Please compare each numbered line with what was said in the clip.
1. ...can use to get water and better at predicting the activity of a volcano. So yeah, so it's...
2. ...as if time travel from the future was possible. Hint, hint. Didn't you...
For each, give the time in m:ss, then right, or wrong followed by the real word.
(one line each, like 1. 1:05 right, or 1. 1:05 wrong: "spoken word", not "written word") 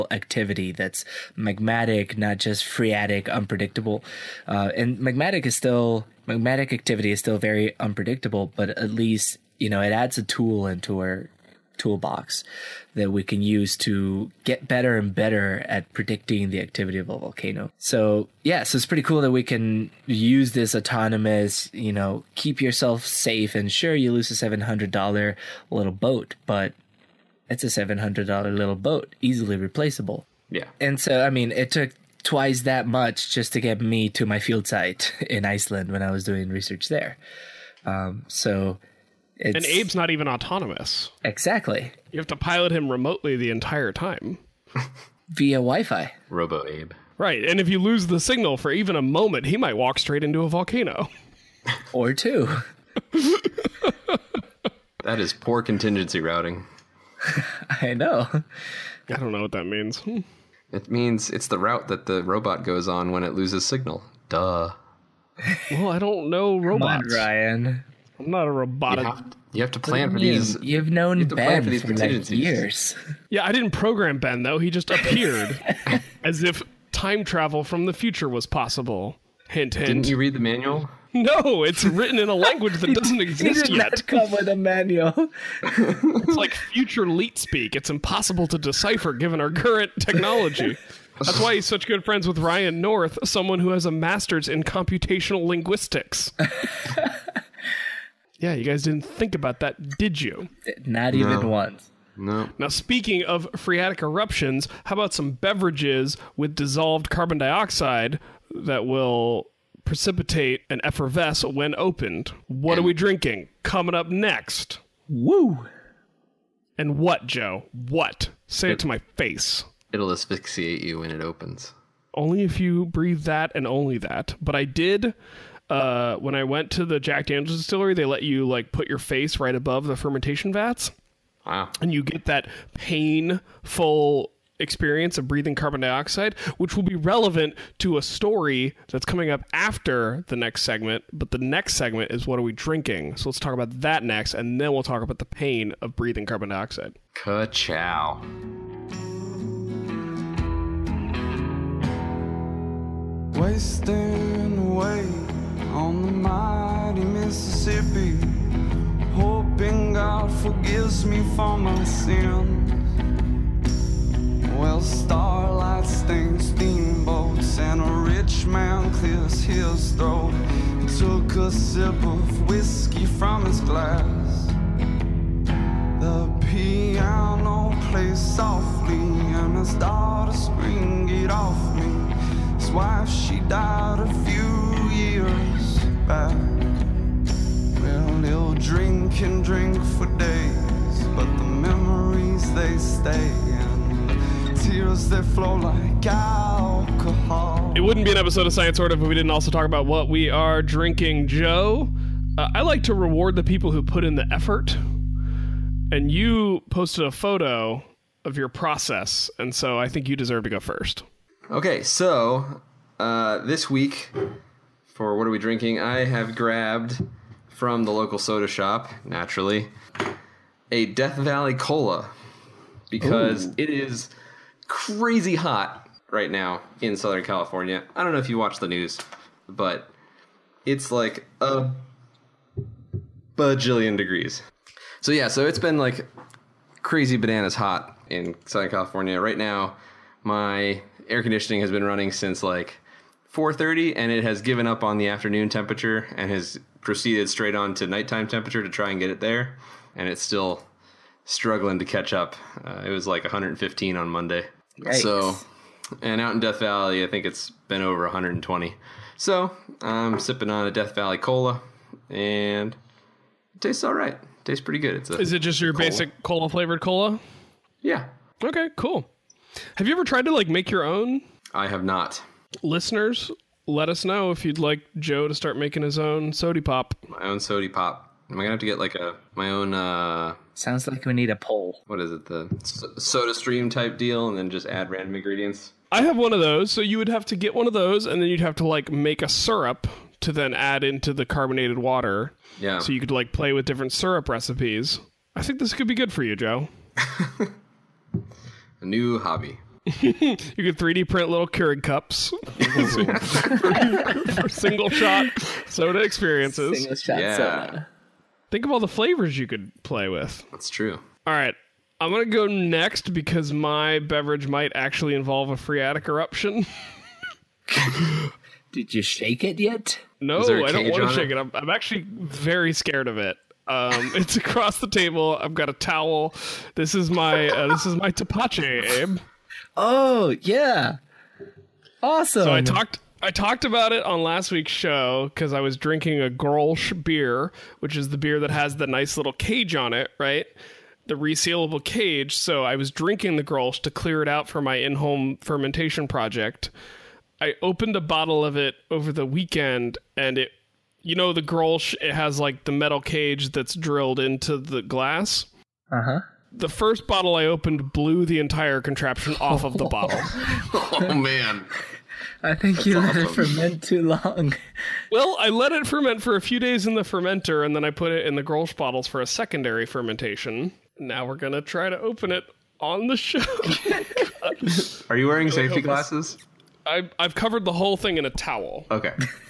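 1. 0:13 wrong: "better", not "water"
2. 1:16 right.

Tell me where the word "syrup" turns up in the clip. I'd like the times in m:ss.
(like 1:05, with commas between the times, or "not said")
4:49, 4:53.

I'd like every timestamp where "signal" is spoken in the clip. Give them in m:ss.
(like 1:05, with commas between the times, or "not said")
0:48, 1:03.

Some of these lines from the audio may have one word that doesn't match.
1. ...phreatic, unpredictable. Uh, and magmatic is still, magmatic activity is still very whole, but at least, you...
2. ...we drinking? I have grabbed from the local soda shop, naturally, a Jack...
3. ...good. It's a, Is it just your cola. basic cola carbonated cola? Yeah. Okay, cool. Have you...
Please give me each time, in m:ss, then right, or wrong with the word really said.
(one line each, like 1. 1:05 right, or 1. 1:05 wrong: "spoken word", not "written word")
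1. 0:02 wrong: "unpredictable", not "whole"
2. 3:35 wrong: "Death", not "Jack"
3. 4:24 wrong: "flavored", not "carbonated".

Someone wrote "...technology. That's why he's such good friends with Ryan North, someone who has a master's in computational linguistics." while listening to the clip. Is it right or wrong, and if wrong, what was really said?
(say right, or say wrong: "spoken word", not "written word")
right.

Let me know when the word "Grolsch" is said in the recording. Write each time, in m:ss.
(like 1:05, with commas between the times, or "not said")
5:36, 5:43, 5:51, 6:08.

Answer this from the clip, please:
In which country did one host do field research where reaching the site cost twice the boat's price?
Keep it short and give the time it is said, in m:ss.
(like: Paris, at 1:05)
Iceland, at 0:35.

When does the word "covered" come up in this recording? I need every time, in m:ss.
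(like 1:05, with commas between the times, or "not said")
6:17.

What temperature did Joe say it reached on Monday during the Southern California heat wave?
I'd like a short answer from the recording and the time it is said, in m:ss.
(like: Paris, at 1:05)
115, at 4:13.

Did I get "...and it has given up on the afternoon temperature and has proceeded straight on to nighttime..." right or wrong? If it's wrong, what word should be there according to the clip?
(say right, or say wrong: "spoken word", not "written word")
right.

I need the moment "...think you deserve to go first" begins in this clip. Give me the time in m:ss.
3:29.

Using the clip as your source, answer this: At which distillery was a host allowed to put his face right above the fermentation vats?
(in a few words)
Jack Daniel's.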